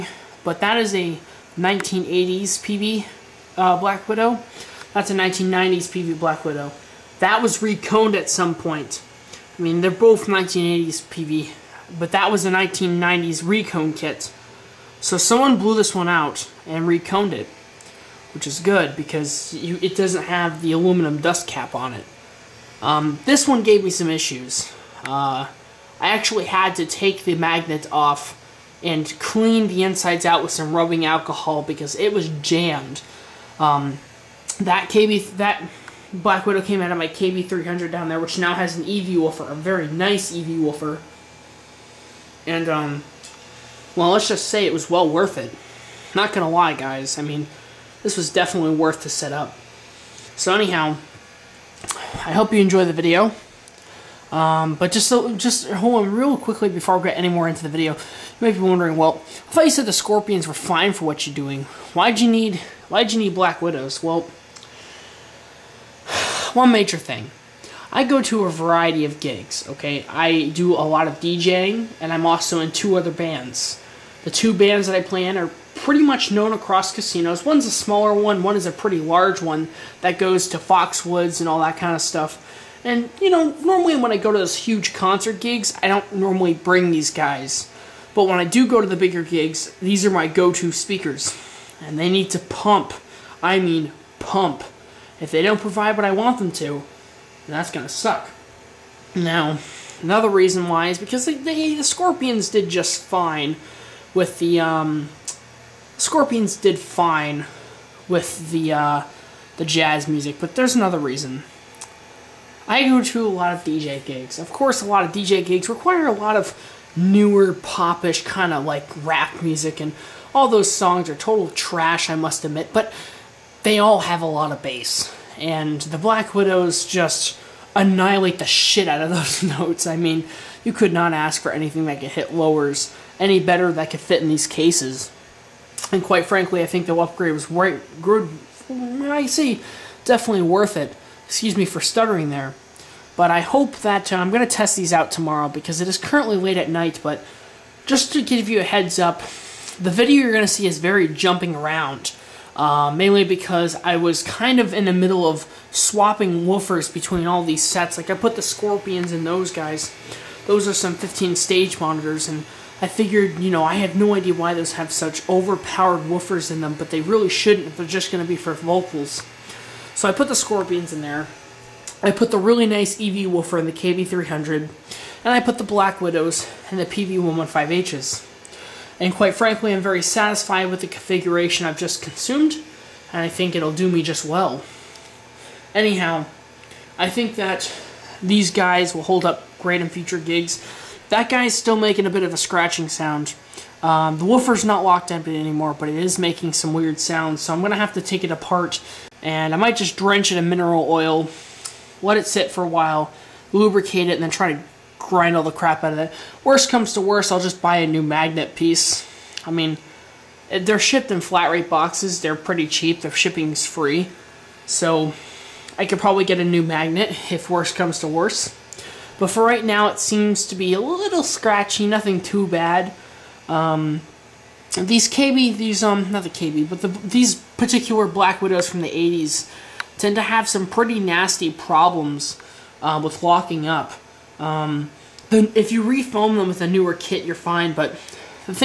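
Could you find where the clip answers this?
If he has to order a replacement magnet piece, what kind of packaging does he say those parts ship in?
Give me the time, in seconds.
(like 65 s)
211 s.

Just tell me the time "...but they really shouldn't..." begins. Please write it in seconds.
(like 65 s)
166 s.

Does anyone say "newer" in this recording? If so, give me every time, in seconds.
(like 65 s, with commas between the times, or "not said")
116 s, 236 s.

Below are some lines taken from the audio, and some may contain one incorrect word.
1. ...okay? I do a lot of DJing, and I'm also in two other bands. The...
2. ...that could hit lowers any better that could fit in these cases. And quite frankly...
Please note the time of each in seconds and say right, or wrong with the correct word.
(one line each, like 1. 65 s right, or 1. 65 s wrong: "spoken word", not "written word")
1. 69 s right
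2. 131 s right.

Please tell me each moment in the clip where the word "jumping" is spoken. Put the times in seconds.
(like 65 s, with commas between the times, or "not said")
151 s.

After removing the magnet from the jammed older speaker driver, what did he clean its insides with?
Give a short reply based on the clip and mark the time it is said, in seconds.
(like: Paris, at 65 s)
Rubbing alcohol, at 30 s.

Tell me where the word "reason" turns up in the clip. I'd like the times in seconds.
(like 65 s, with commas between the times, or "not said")
100 s, 110 s.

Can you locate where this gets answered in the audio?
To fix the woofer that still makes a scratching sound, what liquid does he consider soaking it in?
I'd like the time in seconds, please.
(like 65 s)
200 s.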